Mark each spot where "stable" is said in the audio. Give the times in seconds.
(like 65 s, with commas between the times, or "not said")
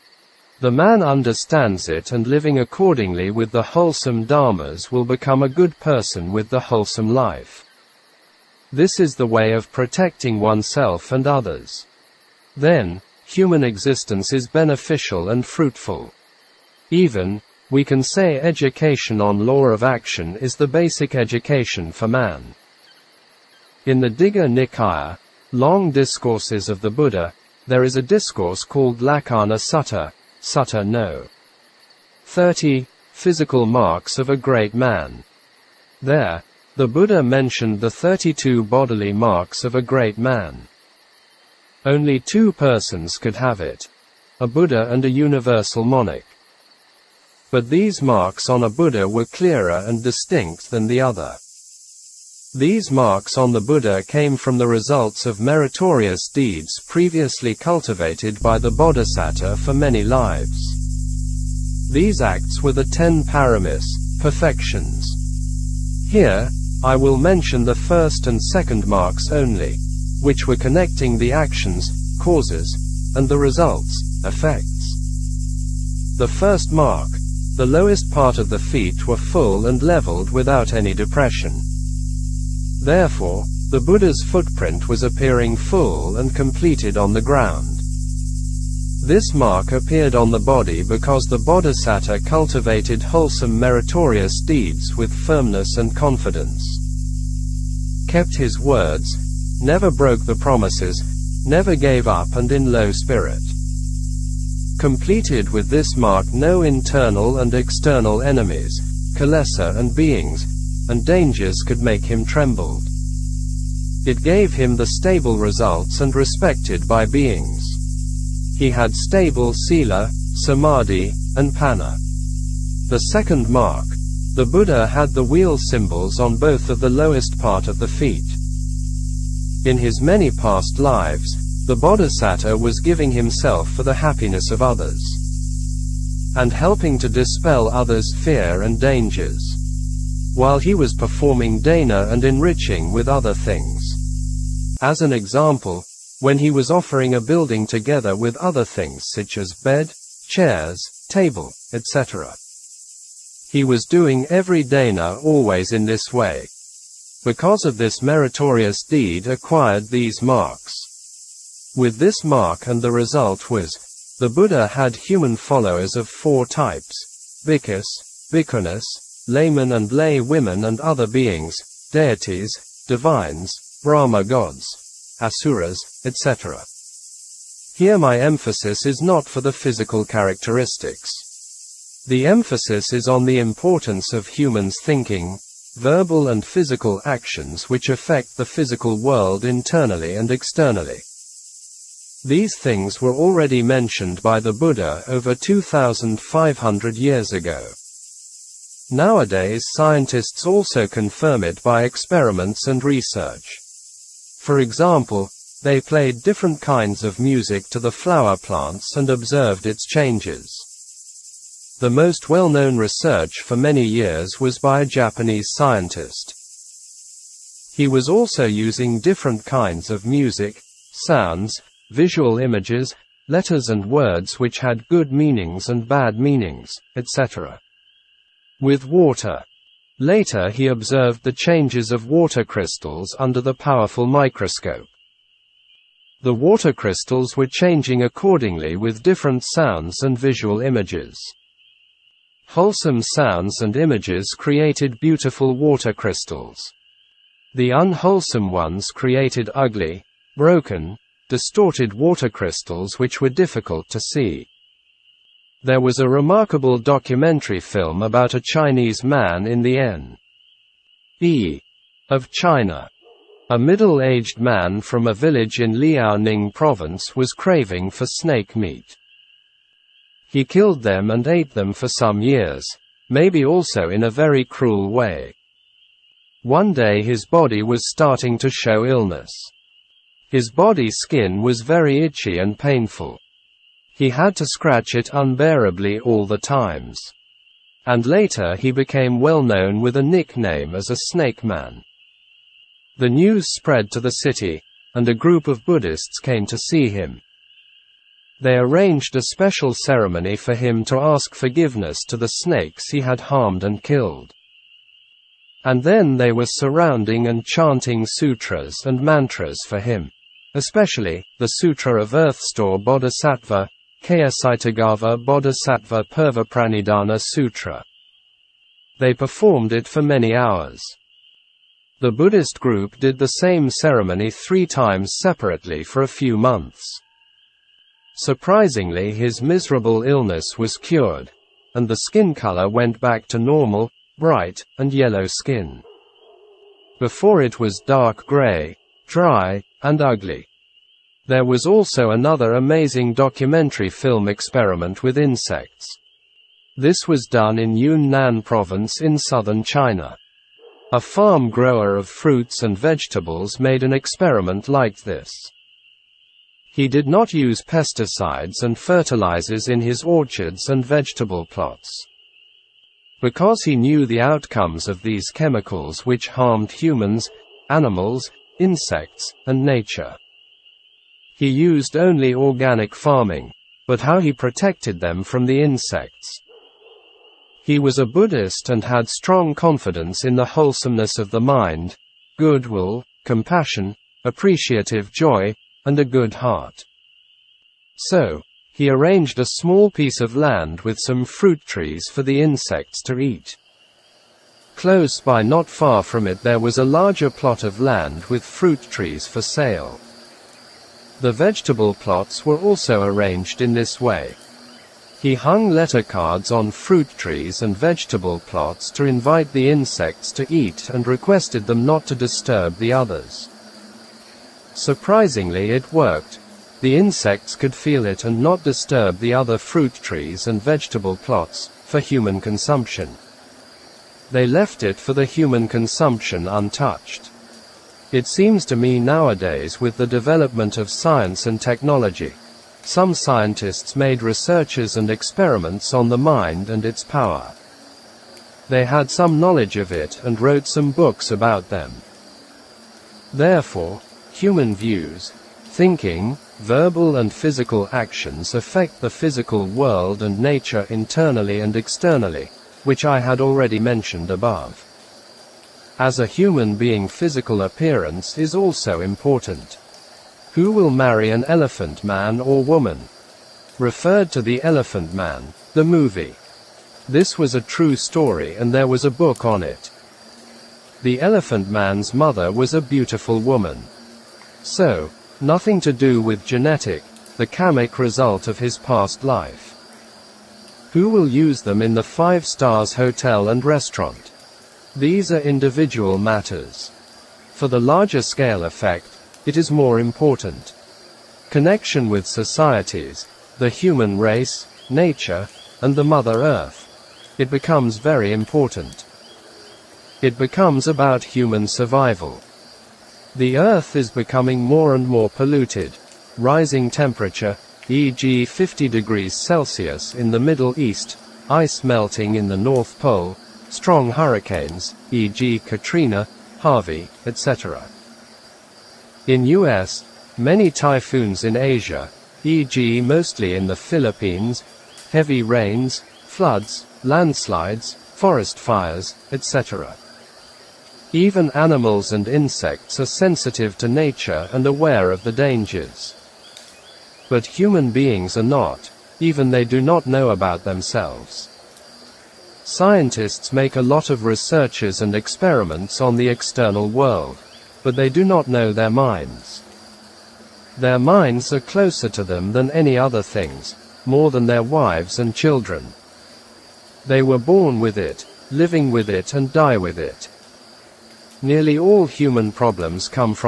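114 s, 118 s.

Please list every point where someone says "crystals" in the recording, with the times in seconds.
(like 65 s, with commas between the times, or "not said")
232 s, 236 s, 245 s, 252 s.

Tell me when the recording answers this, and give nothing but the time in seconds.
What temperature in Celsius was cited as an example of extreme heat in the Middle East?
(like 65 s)
508 s.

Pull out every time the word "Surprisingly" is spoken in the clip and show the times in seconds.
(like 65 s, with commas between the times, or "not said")
328 s, 414 s.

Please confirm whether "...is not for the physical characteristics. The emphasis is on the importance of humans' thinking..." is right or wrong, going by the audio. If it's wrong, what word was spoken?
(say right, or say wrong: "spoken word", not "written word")
right.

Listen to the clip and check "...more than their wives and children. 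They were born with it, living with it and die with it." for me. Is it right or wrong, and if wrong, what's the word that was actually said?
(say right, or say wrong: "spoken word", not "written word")
right.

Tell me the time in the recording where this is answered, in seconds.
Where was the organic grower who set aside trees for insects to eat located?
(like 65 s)
347 s.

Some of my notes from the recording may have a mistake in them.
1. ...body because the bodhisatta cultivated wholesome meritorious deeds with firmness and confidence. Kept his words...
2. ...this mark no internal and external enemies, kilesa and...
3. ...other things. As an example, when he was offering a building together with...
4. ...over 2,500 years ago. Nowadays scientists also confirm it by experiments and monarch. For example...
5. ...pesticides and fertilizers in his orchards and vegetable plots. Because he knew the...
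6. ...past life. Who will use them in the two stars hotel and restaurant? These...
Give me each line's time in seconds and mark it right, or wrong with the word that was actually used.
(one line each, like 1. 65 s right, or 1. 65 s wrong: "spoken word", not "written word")
1. 90 s right
2. 105 s right
3. 143 s right
4. 195 s wrong: "research", not "monarch"
5. 357 s right
6. 478 s wrong: "five", not "two".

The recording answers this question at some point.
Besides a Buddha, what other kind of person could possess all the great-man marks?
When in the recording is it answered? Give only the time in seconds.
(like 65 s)
45 s.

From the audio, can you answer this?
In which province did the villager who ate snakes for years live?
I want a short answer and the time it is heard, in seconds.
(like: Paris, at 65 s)
Liaoning, at 265 s.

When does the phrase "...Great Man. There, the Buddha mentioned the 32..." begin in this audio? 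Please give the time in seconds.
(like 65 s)
34 s.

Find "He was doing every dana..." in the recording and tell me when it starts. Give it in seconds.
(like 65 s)
153 s.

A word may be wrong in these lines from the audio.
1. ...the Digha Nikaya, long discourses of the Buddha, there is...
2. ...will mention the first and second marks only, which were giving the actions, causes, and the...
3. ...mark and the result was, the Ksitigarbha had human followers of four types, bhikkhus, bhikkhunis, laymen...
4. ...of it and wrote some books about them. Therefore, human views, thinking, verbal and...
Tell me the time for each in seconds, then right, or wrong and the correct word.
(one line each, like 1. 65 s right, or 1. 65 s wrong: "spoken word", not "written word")
1. 23 s right
2. 66 s wrong: "connecting", not "giving"
3. 162 s wrong: "Buddha", not "Ksitigarbha"
4. 439 s right.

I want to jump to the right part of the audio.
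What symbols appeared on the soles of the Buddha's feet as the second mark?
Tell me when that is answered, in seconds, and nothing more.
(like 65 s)
125 s.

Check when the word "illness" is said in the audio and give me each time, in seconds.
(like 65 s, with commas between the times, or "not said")
278 s, 330 s.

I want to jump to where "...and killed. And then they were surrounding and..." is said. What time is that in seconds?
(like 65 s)
303 s.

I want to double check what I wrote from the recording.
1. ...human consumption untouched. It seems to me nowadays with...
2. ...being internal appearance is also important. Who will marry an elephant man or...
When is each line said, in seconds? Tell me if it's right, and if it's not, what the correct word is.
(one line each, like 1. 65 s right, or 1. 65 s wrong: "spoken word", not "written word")
1. 425 s right
2. 456 s wrong: "physical", not "internal".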